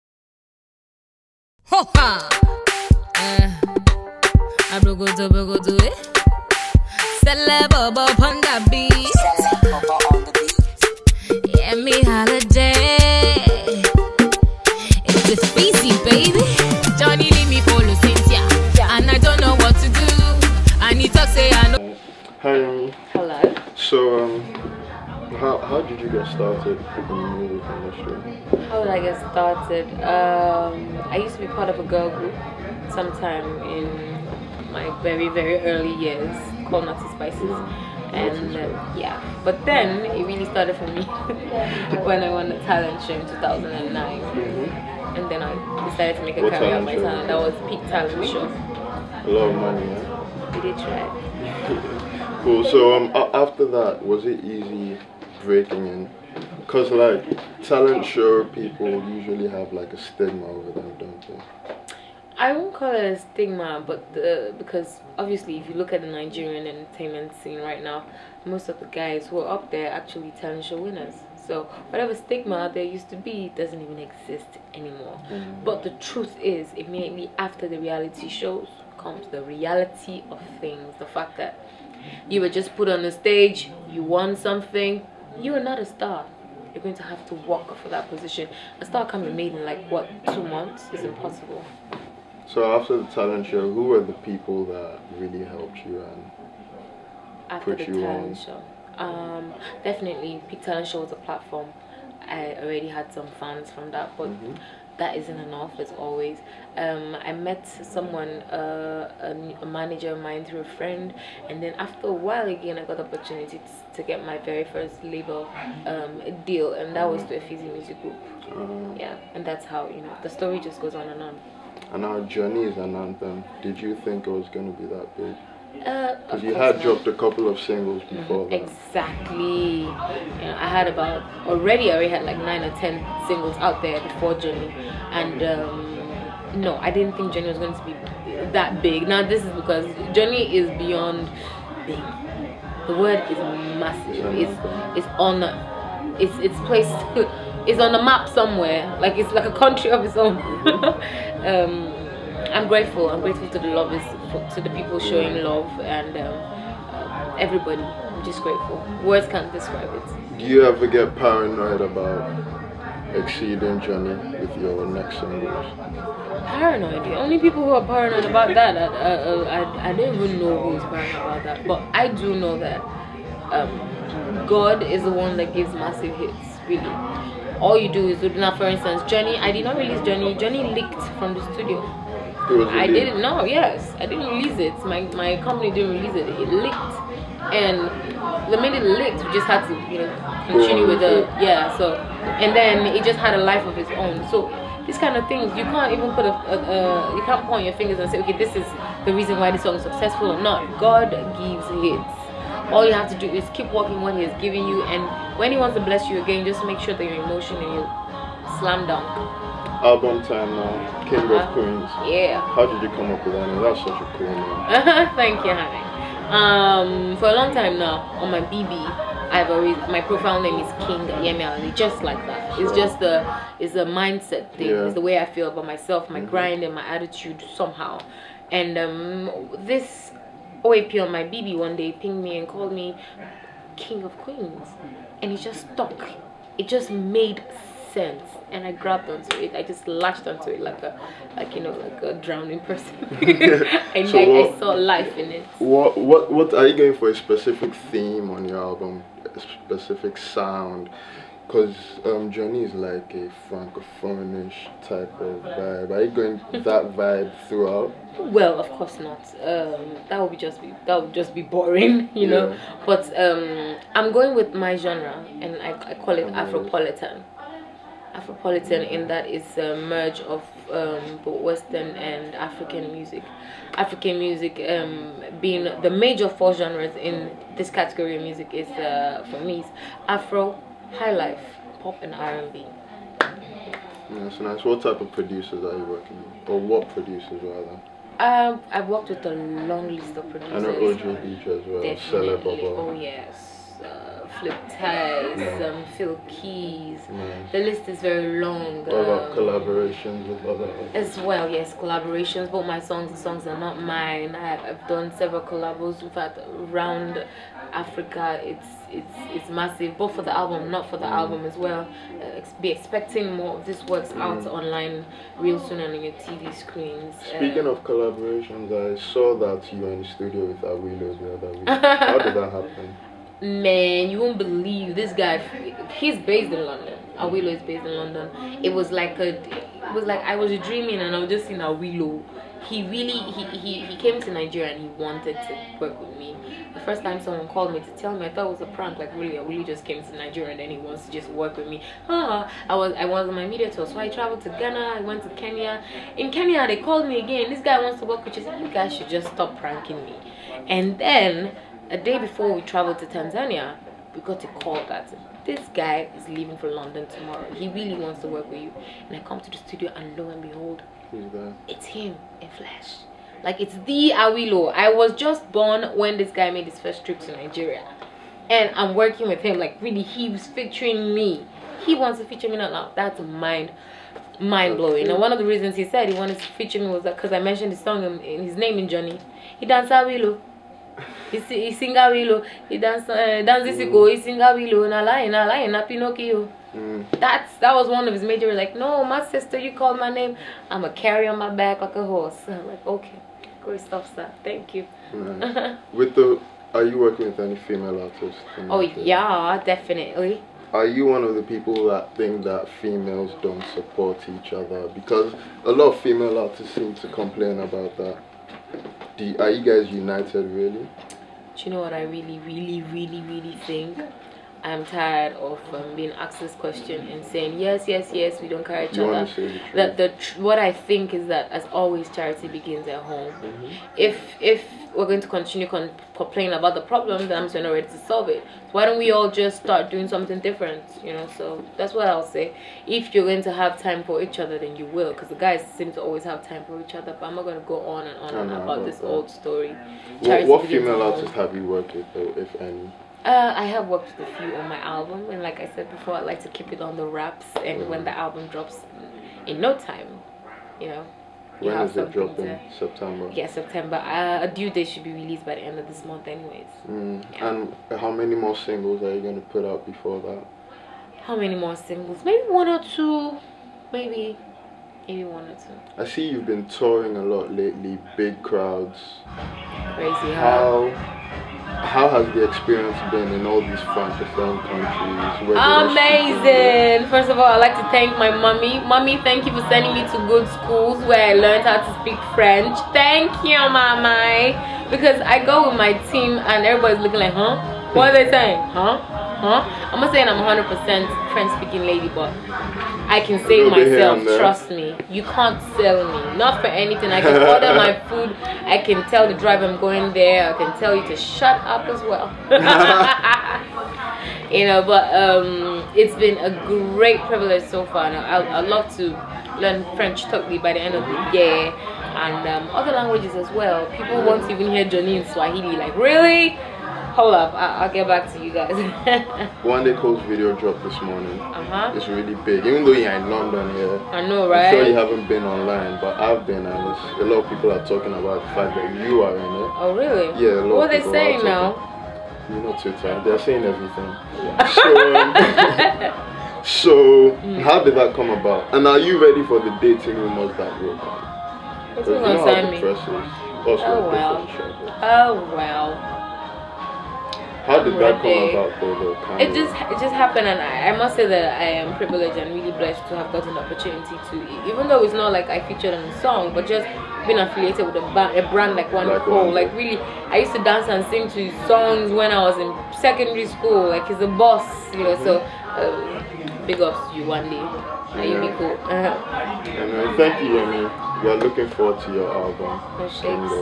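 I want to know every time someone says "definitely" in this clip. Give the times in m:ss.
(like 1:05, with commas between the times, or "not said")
1:39, 4:51, 6:39.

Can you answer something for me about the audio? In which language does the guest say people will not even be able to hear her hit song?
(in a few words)
Swahili.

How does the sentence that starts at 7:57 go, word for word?
First of all, I'd like to thank my mommy.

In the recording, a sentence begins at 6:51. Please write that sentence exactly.
Do you know what I really, really, really, really think?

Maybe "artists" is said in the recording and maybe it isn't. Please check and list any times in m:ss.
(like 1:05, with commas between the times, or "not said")
5:00, 6:38, 6:46, 7:21.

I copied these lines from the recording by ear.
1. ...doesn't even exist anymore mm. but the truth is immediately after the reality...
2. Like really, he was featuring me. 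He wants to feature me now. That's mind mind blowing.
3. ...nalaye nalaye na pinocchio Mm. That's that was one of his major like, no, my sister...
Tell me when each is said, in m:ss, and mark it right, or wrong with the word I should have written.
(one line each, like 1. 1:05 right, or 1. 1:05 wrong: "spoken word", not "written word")
1. 1:13 right
2. 6:09 right
3. 6:24 right.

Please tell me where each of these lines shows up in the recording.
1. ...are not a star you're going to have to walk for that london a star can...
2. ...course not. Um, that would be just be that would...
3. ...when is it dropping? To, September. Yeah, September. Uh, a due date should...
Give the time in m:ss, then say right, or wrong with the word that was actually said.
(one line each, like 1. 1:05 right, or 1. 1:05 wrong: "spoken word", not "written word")
1. 1:25 wrong: "position", not "london"
2. 4:18 right
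3. 7:31 right.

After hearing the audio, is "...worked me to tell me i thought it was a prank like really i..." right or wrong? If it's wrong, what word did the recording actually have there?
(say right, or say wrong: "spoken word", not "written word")
wrong: "called", not "worked".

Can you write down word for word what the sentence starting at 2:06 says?
dropped a couple of singles mm-hmm.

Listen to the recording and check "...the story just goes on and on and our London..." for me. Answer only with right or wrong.
wrong.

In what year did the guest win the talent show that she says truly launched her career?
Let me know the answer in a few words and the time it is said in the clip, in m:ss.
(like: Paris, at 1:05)
2009, at 0:43.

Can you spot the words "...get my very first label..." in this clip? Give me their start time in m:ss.
1:54.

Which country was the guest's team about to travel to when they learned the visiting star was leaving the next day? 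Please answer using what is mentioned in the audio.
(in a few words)
Tanzania.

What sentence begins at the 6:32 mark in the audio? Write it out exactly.
I'm like, okay, great stuff, sir.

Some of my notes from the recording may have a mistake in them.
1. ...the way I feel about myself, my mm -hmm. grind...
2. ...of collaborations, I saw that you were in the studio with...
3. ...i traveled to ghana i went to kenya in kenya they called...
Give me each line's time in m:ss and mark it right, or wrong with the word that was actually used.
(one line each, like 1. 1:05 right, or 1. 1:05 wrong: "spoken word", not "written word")
1. 3:44 right
2. 5:17 right
3. 5:43 right.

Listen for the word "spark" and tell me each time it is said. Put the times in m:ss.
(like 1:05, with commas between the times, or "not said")
not said.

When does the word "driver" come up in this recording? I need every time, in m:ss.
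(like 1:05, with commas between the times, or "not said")
8:19.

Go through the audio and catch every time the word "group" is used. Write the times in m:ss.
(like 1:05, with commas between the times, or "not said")
0:32, 1:58.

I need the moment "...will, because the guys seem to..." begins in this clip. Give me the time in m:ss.
7:14.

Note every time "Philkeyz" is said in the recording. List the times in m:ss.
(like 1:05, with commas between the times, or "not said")
4:55.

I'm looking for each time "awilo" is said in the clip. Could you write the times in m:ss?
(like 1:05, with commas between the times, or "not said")
5:20, 5:27, 5:31, 6:04, 6:19.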